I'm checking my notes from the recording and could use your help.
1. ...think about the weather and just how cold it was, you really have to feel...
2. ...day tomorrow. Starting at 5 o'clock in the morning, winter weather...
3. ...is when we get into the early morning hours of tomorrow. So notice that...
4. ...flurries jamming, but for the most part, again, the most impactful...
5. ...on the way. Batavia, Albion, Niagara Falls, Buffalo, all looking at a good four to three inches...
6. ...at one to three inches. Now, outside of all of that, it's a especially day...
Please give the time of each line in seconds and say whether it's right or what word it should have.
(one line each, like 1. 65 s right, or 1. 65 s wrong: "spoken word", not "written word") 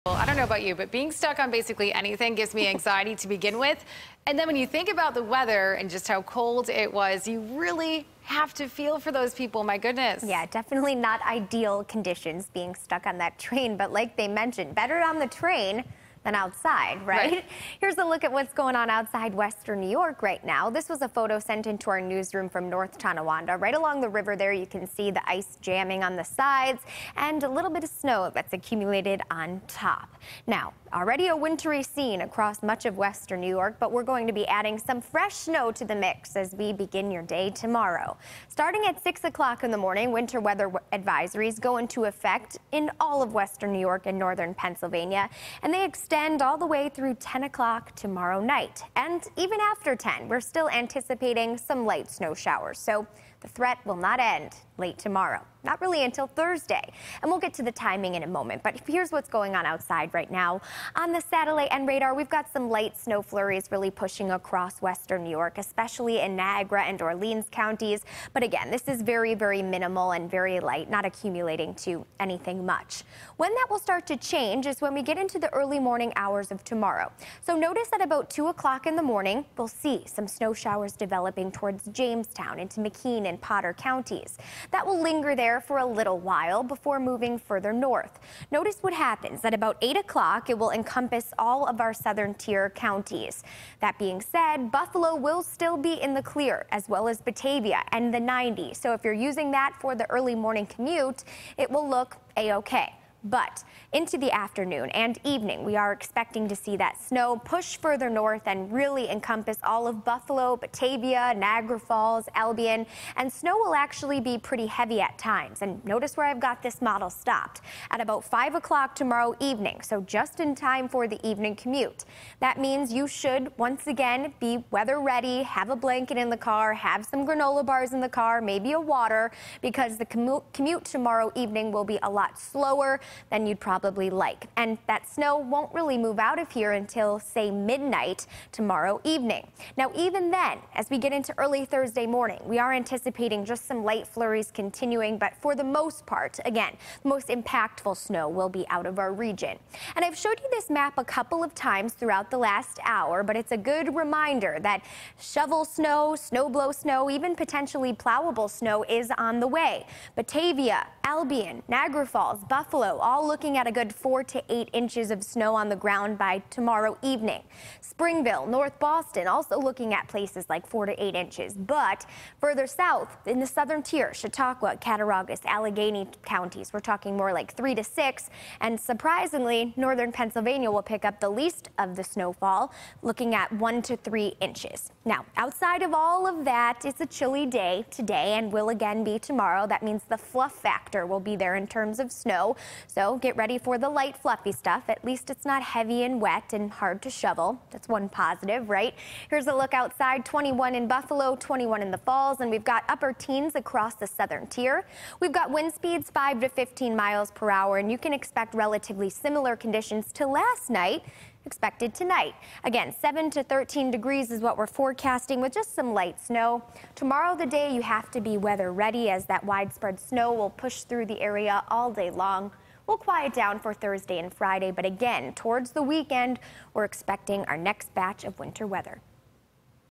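1. 4 s right
2. 37 s wrong: "6", not "5"
3. 74 s right
4. 144 s wrong: "continuing", not "jamming"
5. 159 s wrong: "eight", not "three"
6. 183 s wrong: "chilly", not "especially".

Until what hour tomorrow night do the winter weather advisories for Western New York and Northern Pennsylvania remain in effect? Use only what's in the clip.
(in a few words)
10 o'clock.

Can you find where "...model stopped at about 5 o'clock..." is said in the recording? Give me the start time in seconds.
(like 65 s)
116 s.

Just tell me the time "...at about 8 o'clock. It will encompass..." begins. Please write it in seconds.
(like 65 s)
89 s.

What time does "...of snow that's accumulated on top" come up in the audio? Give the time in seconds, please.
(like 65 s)
27 s.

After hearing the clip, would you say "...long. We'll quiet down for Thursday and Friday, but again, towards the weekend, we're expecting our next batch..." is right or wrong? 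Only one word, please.
right.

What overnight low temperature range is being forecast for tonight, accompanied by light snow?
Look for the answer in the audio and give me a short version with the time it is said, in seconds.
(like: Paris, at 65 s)
7 to 13 degrees, at 212 s.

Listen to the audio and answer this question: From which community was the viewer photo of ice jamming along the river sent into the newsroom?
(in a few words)
North Tonawanda.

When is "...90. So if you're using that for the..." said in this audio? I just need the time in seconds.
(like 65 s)
98 s.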